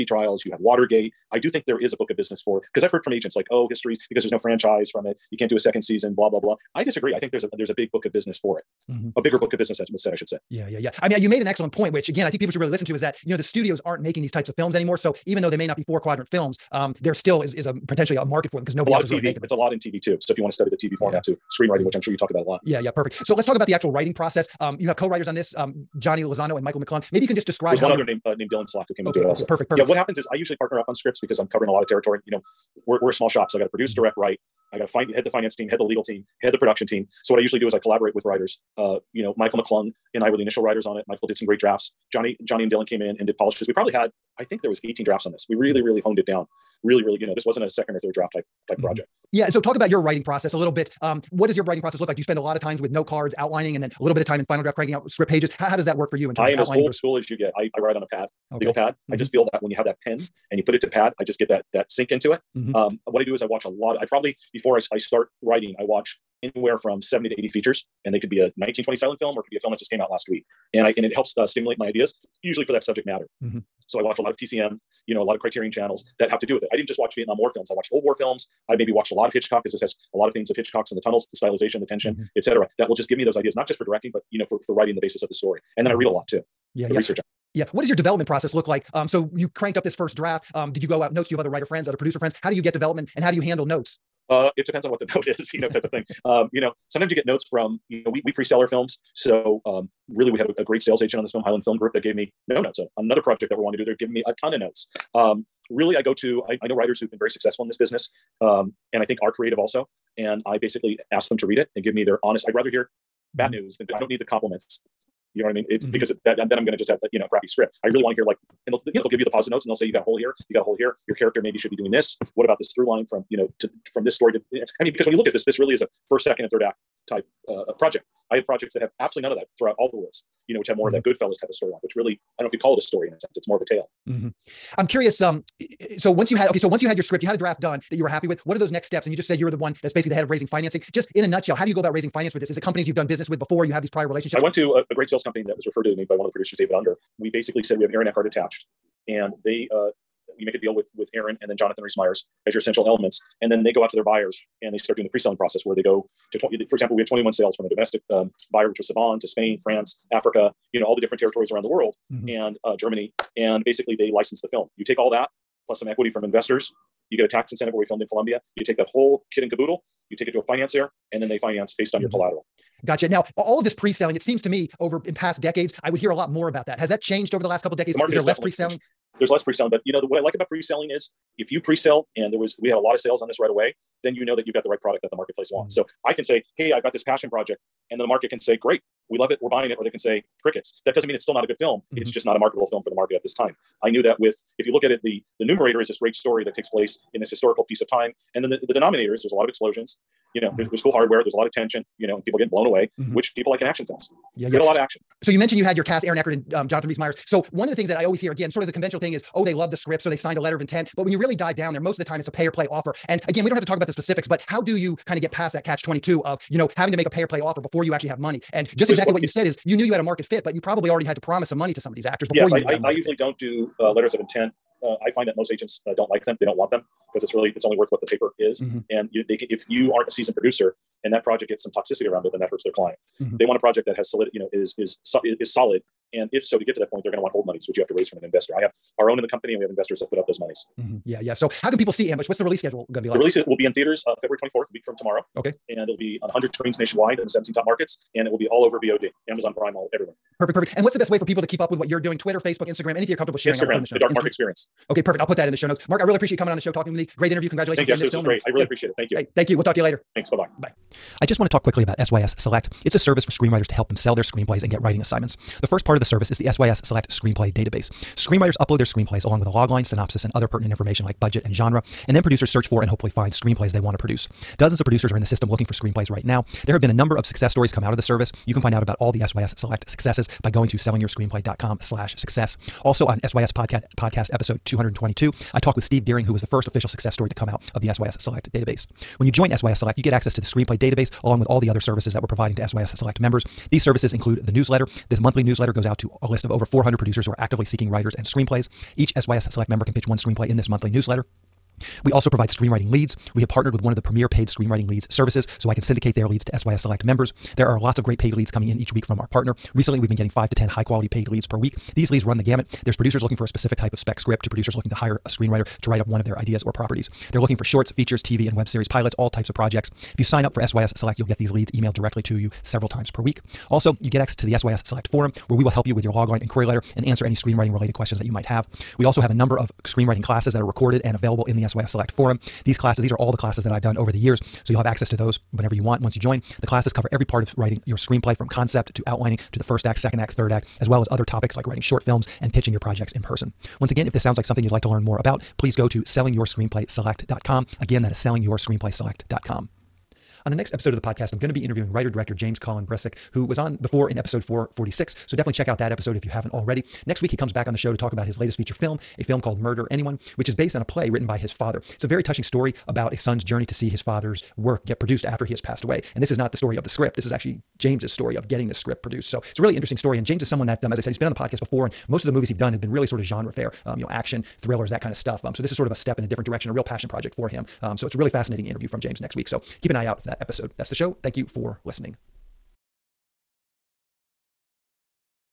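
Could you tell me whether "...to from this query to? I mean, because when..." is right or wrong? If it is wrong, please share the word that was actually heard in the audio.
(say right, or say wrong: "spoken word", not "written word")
wrong: "story", not "query".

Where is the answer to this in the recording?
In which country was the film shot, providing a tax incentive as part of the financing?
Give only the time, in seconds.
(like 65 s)
168 s.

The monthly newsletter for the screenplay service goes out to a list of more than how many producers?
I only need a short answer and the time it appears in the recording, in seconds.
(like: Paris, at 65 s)
400, at 296 s.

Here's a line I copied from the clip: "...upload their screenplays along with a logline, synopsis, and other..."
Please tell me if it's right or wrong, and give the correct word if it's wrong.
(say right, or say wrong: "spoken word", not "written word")
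right.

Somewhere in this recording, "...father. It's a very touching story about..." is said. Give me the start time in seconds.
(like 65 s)
361 s.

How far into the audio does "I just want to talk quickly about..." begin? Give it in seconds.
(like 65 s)
261 s.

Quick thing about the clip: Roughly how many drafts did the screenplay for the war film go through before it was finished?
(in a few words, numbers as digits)
18.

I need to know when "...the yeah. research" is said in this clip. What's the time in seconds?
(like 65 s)
86 s.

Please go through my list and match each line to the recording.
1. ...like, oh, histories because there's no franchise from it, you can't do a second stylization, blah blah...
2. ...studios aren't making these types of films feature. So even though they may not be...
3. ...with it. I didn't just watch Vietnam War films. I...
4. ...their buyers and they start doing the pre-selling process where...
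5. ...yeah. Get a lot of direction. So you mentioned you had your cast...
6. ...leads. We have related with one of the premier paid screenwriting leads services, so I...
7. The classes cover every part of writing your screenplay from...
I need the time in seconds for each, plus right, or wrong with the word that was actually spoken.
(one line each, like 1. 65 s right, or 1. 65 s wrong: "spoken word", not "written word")
1. 3 s wrong: "season", not "stylization"
2. 13 s wrong: "anymore", not "feature"
3. 76 s right
4. 153 s right
5. 204 s wrong: "action", not "direction"
6. 302 s wrong: "partnered", not "related"
7. 336 s right.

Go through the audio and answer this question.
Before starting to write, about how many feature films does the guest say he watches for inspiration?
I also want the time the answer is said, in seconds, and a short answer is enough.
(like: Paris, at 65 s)
70 to 80, at 67 s.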